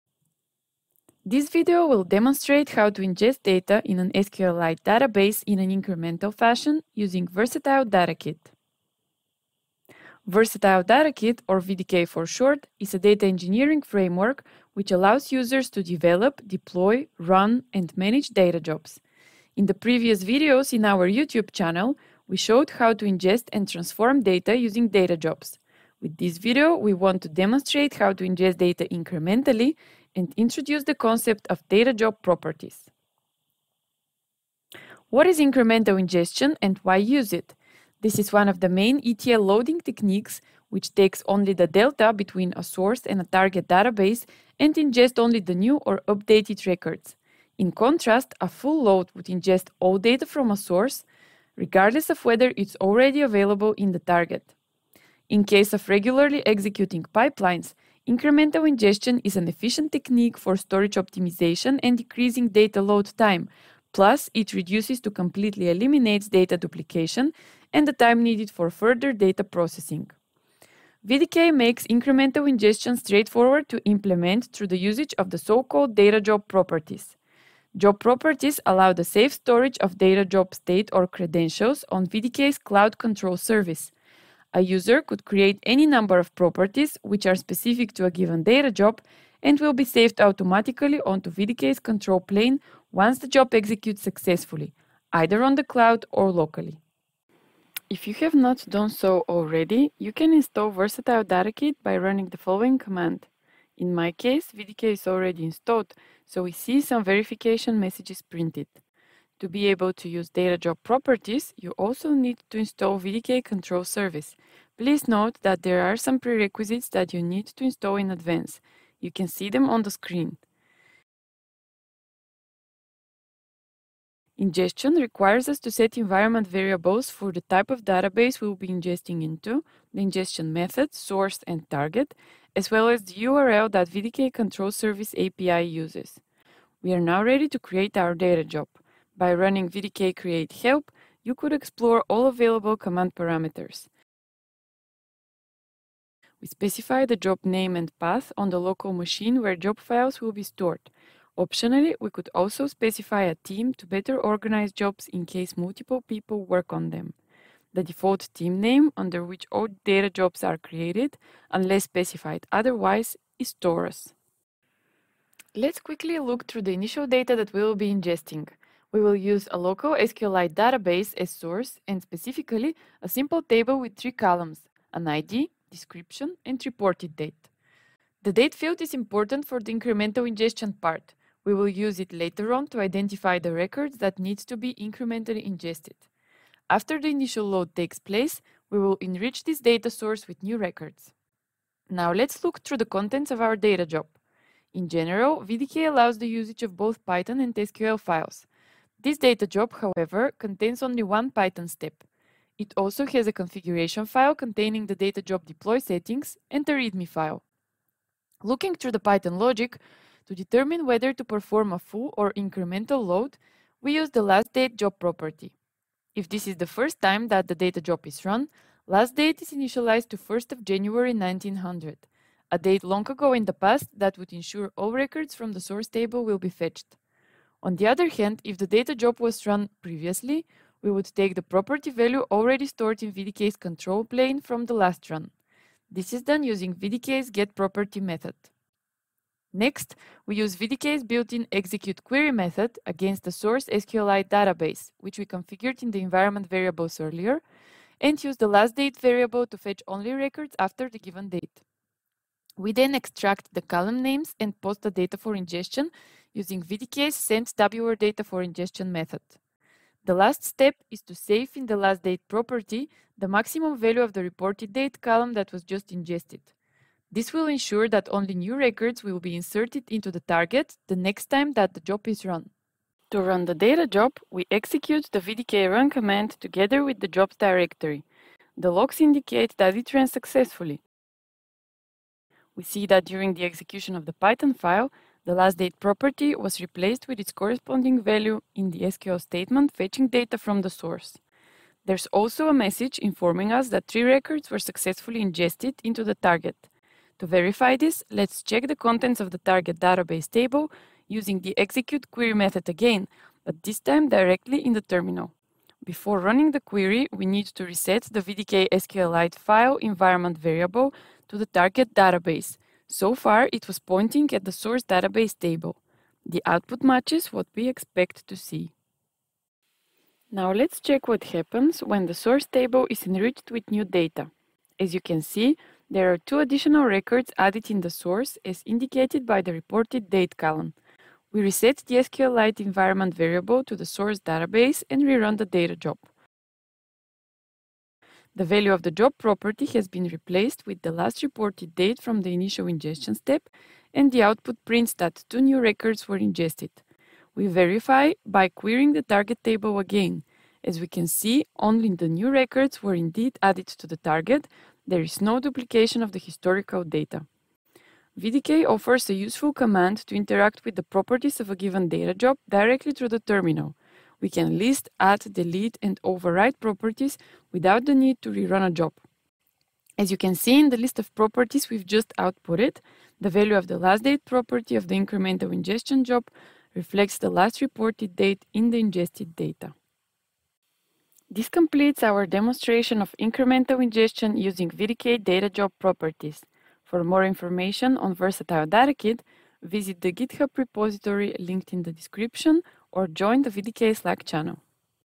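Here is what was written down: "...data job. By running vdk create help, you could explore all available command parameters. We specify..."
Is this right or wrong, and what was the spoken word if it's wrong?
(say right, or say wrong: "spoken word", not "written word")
right.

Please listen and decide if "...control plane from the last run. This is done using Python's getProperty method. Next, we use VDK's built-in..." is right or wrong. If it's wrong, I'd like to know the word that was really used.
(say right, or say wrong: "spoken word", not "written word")
wrong: "VDK", not "Python".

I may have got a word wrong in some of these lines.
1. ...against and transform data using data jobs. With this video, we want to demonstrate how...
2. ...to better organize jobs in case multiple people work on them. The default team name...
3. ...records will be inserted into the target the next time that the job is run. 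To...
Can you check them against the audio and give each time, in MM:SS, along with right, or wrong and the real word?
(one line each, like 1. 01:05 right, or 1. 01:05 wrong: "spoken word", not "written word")
1. 00:23 wrong: "ingest", not "against"
2. 02:33 right
3. 04:28 right.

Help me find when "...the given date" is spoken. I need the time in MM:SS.
04:10.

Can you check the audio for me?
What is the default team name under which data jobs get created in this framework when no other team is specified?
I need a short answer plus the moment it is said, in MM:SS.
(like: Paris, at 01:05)
Taurus, at 02:43.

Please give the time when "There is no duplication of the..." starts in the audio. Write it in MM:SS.
05:54.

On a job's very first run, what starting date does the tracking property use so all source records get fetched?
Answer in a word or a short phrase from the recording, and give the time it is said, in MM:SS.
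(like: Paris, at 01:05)
1 January 1900, at 03:40.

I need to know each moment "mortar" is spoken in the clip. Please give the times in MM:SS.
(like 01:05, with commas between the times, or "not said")
not said.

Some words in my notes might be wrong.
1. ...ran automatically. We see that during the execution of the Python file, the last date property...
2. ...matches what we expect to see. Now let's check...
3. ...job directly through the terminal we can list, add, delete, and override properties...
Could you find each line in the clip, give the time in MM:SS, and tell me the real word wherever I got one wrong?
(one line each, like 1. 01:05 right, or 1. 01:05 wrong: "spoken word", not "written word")
1. 04:39 wrong: "successfully", not "automatically"
2. 05:16 right
3. 06:02 right.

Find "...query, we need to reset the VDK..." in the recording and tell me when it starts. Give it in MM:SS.
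05:06.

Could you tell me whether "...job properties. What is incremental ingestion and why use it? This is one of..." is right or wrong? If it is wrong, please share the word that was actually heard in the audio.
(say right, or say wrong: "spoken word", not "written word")
right.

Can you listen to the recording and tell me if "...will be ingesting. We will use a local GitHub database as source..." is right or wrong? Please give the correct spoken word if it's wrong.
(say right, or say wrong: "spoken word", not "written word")
wrong: "SQLite", not "GitHub".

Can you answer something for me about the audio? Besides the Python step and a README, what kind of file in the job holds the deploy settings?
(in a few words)
configuration file.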